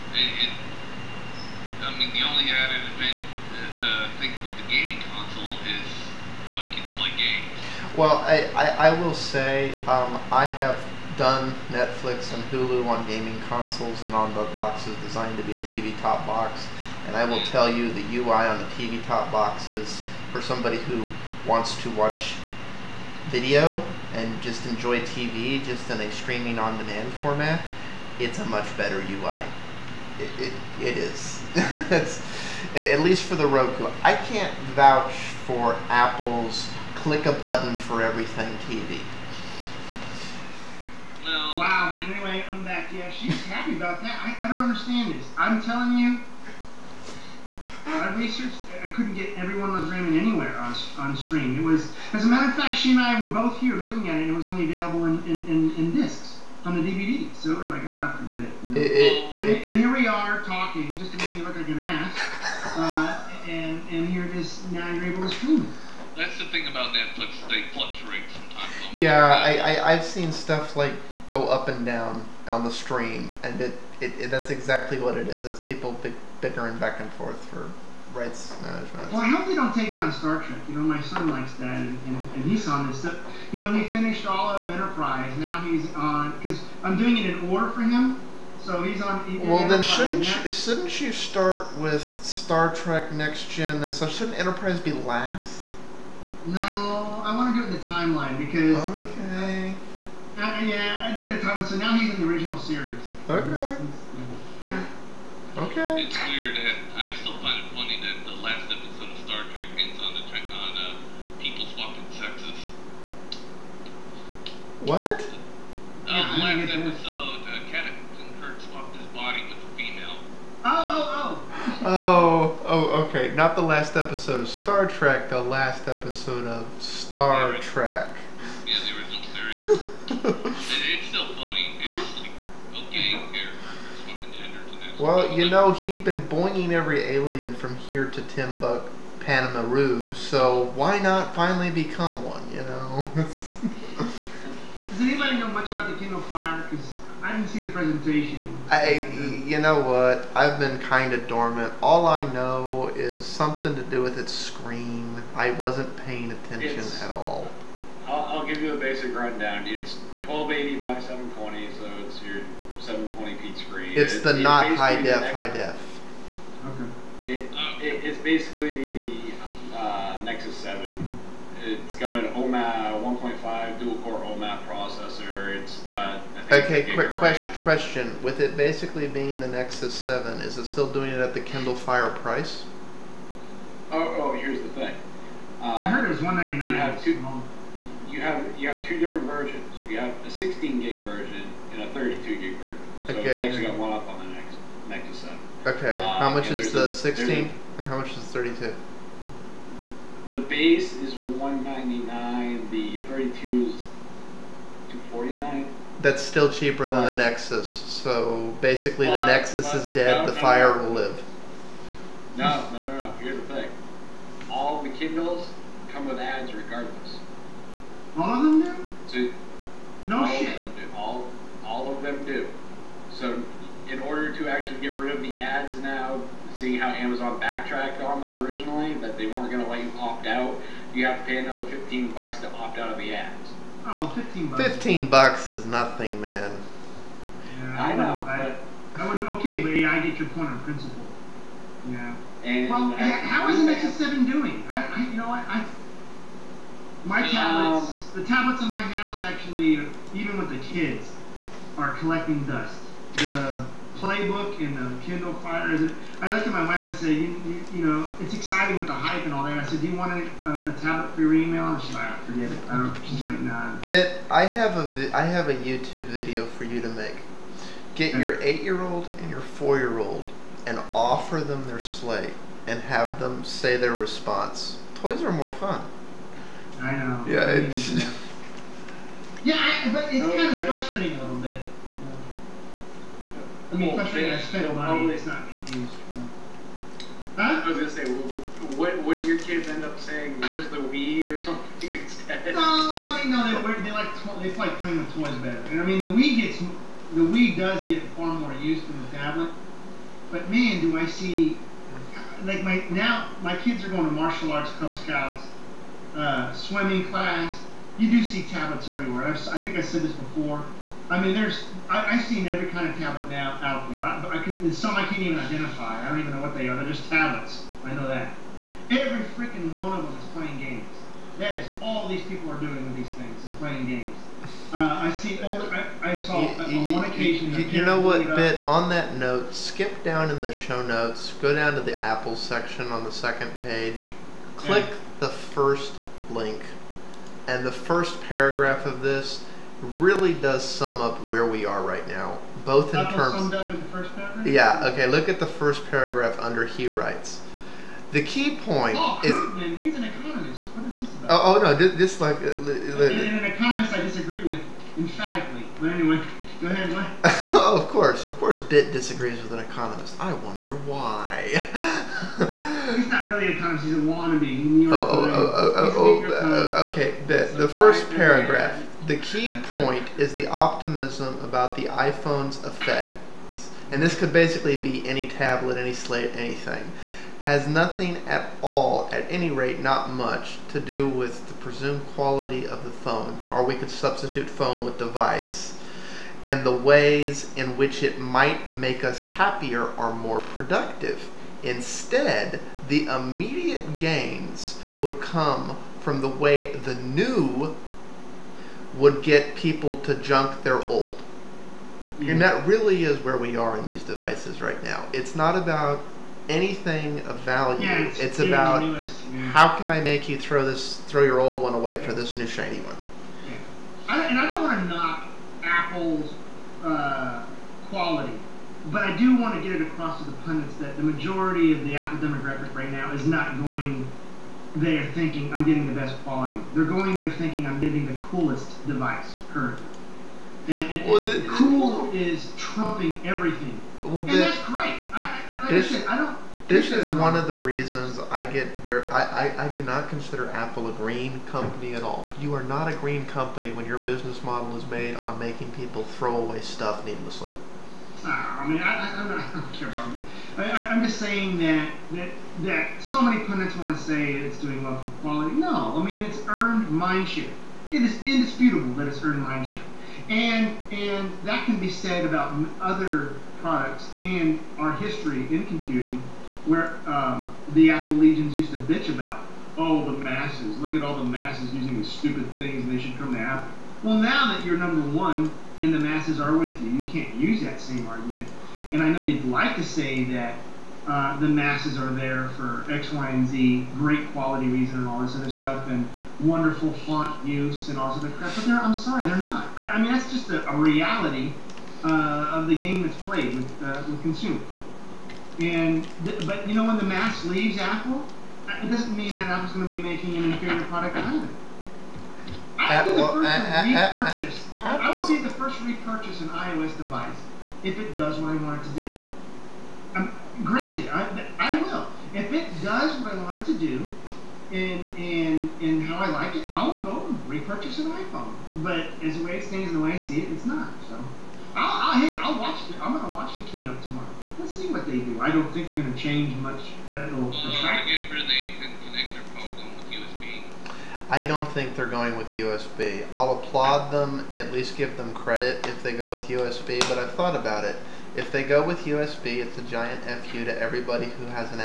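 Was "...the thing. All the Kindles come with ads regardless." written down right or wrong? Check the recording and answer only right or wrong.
right.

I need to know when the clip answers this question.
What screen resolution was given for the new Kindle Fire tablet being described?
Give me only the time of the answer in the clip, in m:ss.
2:40.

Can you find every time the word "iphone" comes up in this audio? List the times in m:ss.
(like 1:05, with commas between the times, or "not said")
6:11, 8:38.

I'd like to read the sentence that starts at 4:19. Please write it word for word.
I said, do you want a, a, a tablet for your email?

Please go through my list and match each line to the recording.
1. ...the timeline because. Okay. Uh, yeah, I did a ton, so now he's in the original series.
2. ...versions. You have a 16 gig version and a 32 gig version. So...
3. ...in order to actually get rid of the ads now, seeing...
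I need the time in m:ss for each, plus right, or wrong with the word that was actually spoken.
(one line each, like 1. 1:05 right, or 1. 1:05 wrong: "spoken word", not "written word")
1. 1:37 right
2. 3:09 right
3. 3:43 right.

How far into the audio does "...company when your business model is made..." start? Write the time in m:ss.
7:23.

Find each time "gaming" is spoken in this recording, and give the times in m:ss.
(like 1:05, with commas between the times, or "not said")
0:04, 0:13.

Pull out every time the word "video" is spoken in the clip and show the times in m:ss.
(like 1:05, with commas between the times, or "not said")
0:23, 4:26.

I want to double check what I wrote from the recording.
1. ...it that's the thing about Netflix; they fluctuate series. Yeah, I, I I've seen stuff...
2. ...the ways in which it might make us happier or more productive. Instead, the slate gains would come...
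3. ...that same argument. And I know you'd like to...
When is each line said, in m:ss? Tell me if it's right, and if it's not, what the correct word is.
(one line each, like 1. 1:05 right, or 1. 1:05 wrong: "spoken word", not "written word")
1. 1:05 wrong: "sometimes", not "series"
2. 6:26 wrong: "immediate", not "slate"
3. 7:57 right.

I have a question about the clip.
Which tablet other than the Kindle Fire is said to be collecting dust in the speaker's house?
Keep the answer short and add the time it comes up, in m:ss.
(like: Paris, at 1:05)
PlayBook, at 4:13.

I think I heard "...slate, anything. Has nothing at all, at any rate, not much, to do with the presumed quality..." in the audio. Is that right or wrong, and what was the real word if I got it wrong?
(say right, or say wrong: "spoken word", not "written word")
right.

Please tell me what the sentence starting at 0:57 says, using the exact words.
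So we're like, ah, forget it.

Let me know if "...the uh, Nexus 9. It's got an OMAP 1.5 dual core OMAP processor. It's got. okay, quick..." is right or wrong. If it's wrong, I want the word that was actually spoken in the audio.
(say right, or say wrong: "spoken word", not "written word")
wrong: "7", not "9".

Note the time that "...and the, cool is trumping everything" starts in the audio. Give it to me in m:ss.
7:11.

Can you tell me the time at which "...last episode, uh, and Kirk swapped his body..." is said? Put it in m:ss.
1:56.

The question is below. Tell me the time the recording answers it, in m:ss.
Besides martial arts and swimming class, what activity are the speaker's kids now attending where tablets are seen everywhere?
5:04.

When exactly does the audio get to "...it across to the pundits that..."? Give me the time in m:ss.
6:59.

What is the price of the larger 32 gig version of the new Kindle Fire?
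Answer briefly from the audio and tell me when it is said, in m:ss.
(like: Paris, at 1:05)
$249, at 3:24.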